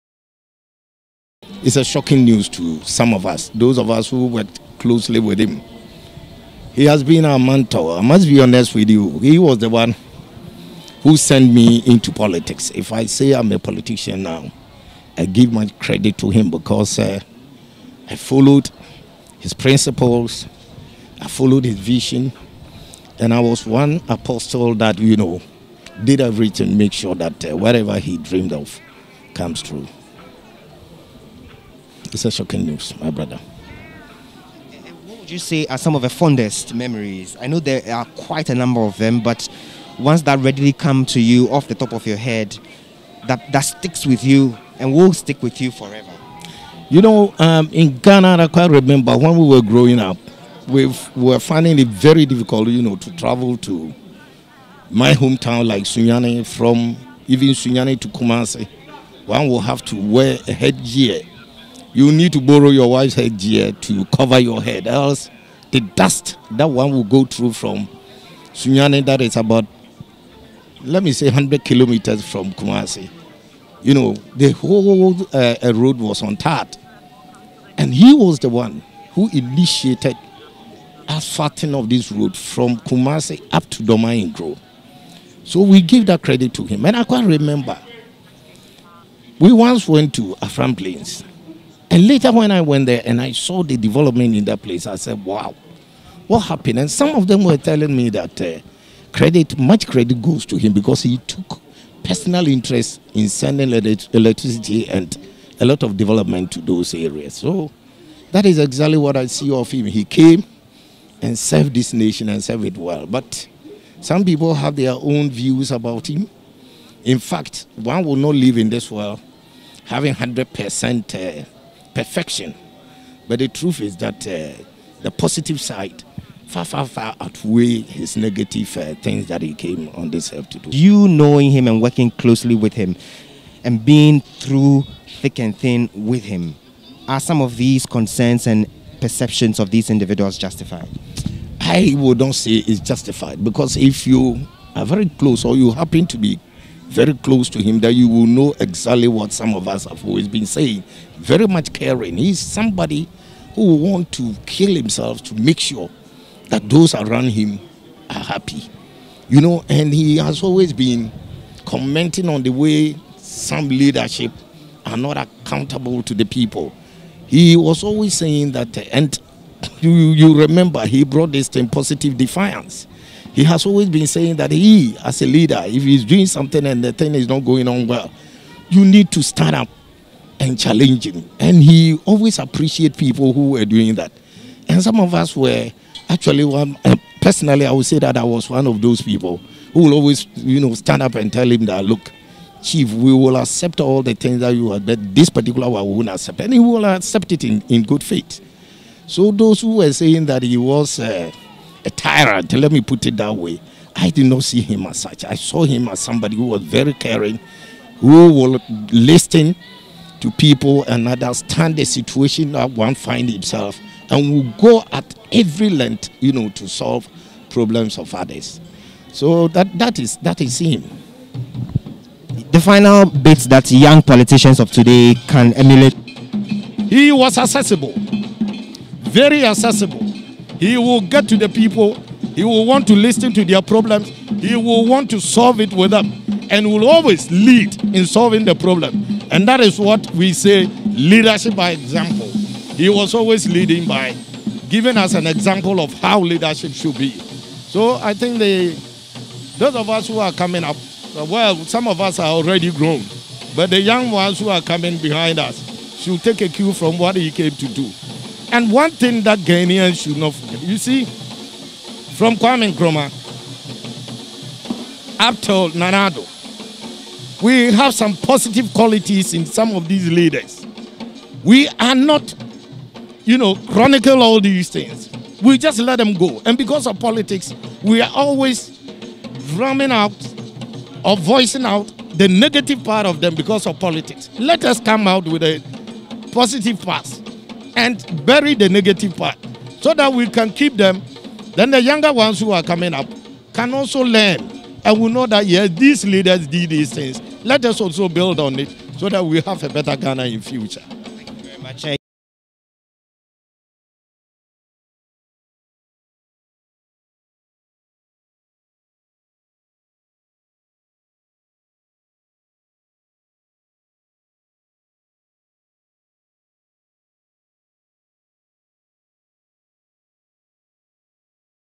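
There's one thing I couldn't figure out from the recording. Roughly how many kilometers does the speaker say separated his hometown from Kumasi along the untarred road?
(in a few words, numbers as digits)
100.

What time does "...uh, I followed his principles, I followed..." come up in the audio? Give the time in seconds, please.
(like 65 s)
16 s.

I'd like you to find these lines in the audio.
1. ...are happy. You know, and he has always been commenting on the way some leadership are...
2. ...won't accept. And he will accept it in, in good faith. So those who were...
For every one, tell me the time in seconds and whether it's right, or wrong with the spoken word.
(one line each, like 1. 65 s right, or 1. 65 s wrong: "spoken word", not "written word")
1. 158 s right
2. 195 s right.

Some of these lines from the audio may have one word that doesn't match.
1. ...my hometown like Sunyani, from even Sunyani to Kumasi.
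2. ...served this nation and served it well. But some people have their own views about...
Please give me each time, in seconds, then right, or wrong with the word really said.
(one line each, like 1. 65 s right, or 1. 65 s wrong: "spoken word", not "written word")
1. 54 s right
2. 111 s right.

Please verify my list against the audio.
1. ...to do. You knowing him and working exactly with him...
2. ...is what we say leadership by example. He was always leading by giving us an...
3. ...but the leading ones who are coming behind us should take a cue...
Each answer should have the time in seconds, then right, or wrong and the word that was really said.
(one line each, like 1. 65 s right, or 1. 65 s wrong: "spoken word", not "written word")
1. 130 s wrong: "closely", not "exactly"
2. 239 s right
3. 253 s wrong: "young", not "leading".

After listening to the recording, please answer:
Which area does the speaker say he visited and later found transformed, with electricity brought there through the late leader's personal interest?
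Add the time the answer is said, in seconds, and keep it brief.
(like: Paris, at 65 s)
Afram Plains, at 90 s.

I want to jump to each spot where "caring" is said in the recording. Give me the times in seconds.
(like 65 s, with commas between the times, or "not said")
151 s, 206 s.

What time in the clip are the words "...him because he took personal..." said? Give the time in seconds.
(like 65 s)
100 s.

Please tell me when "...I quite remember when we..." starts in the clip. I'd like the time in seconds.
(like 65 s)
48 s.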